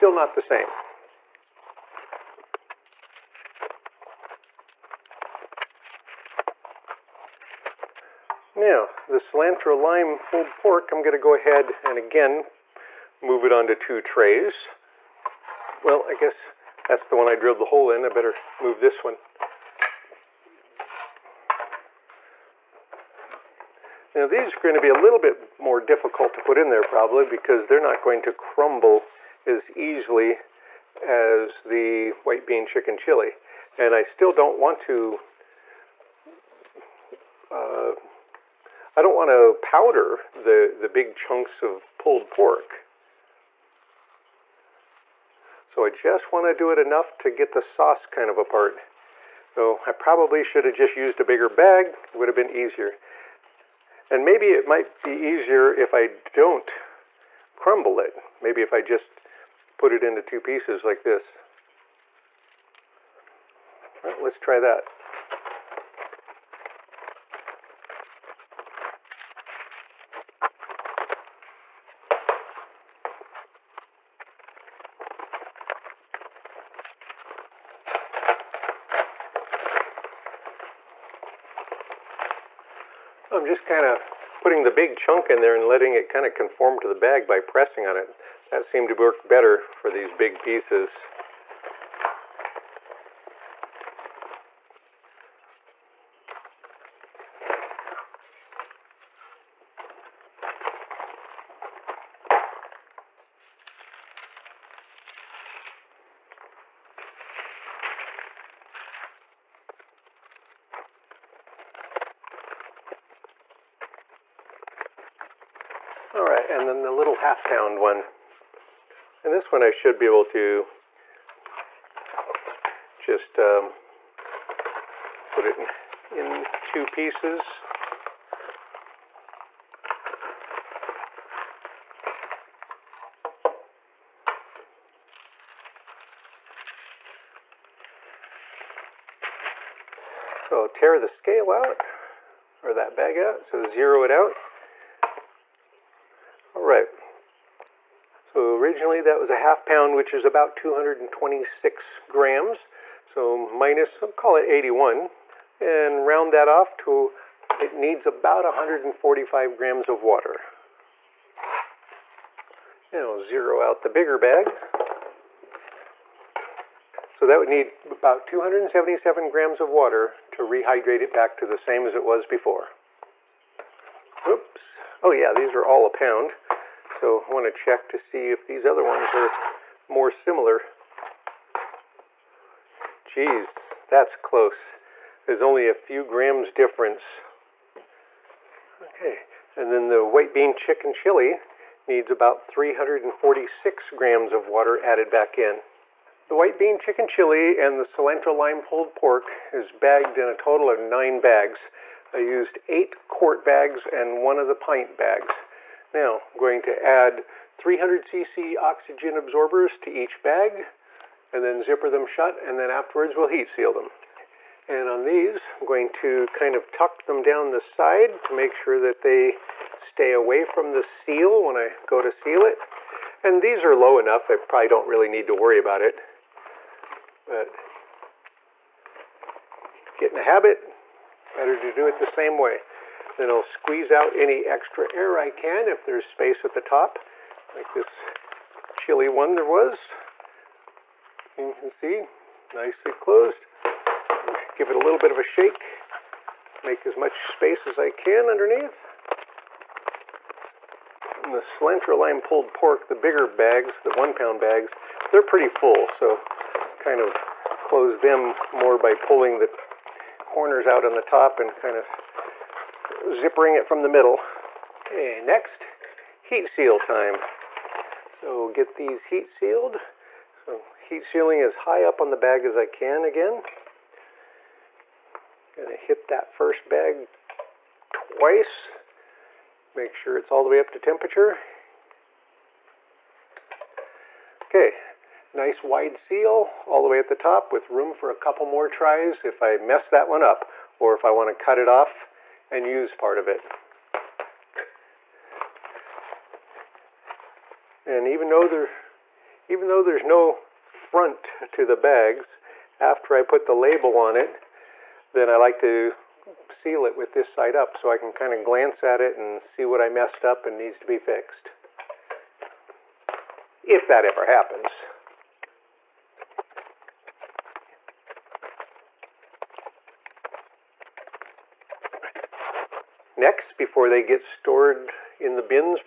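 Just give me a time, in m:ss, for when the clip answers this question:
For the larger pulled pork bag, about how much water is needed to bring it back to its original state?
2:48.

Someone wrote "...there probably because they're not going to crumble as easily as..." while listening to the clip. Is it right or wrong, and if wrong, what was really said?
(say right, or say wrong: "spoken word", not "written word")
right.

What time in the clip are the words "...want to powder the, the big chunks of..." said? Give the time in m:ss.
0:39.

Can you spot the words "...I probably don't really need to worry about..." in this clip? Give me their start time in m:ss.
3:44.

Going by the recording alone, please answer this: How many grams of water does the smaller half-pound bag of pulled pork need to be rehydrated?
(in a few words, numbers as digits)
145 grams.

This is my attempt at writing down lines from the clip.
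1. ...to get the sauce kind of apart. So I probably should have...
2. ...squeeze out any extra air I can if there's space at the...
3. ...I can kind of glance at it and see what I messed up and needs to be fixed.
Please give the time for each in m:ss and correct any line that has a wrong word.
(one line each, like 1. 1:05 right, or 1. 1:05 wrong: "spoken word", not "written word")
1. 0:47 right
2. 3:53 right
3. 5:07 right.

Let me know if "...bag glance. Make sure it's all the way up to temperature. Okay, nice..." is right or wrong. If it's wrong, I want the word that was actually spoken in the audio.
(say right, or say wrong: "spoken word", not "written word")
wrong: "twice", not "glance".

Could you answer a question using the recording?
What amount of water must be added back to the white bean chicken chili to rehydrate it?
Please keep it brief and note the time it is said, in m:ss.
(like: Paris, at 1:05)
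346 grams, at 3:12.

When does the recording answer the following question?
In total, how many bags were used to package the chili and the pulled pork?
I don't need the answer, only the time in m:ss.
3:20.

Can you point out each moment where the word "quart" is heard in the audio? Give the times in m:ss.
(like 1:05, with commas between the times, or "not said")
3:23.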